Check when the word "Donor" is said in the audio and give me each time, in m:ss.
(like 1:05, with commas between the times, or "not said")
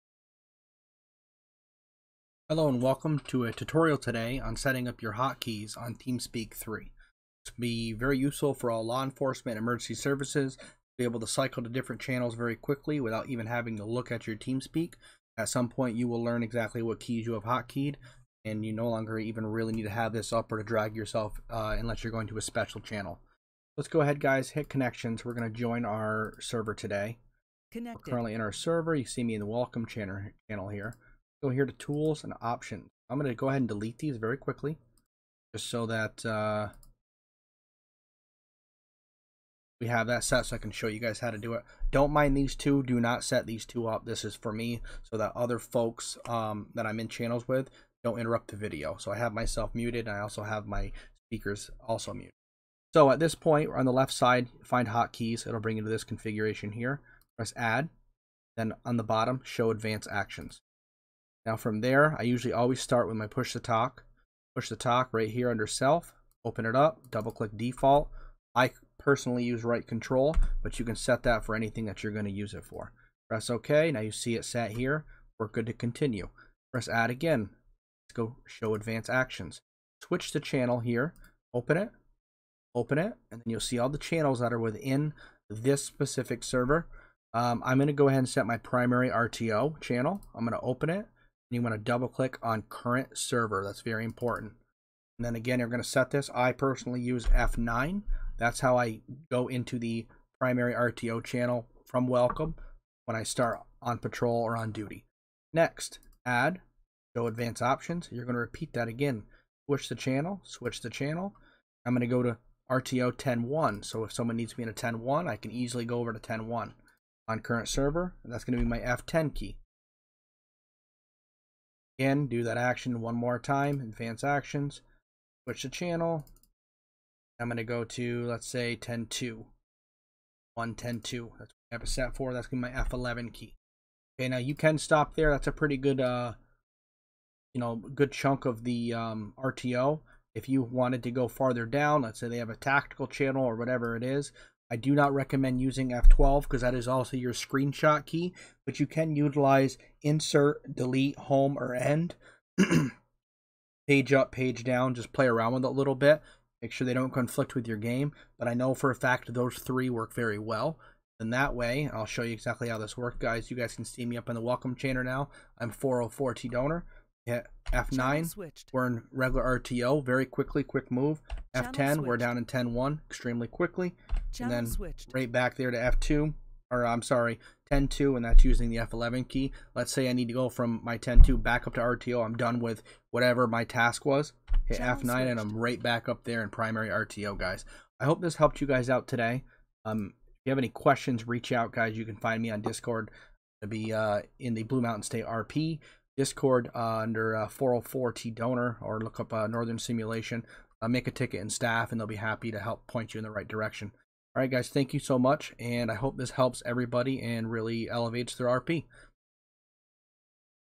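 2:46, 3:18.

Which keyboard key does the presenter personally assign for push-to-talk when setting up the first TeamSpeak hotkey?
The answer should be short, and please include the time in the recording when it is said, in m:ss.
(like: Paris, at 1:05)
Right control, at 1:09.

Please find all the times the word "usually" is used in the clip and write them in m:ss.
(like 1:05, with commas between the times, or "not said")
1:02.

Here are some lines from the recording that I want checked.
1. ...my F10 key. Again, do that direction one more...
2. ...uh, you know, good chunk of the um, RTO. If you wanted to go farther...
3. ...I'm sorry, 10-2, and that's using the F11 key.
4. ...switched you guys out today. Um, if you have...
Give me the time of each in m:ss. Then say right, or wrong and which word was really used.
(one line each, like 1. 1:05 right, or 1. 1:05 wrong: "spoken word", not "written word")
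1. 1:58 wrong: "action", not "direction"
2. 2:16 right
3. 2:56 right
4. 3:08 wrong: "helped", not "switched".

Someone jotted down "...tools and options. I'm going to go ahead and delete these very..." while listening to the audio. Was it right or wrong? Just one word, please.
right.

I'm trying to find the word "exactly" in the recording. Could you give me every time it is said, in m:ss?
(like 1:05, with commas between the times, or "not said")
0:16, 2:42.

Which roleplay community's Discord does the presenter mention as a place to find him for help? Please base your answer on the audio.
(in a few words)
Blue Mountain State RP.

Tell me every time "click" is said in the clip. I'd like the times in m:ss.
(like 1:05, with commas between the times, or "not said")
1:07, 1:32.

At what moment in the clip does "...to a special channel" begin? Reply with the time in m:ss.
0:22.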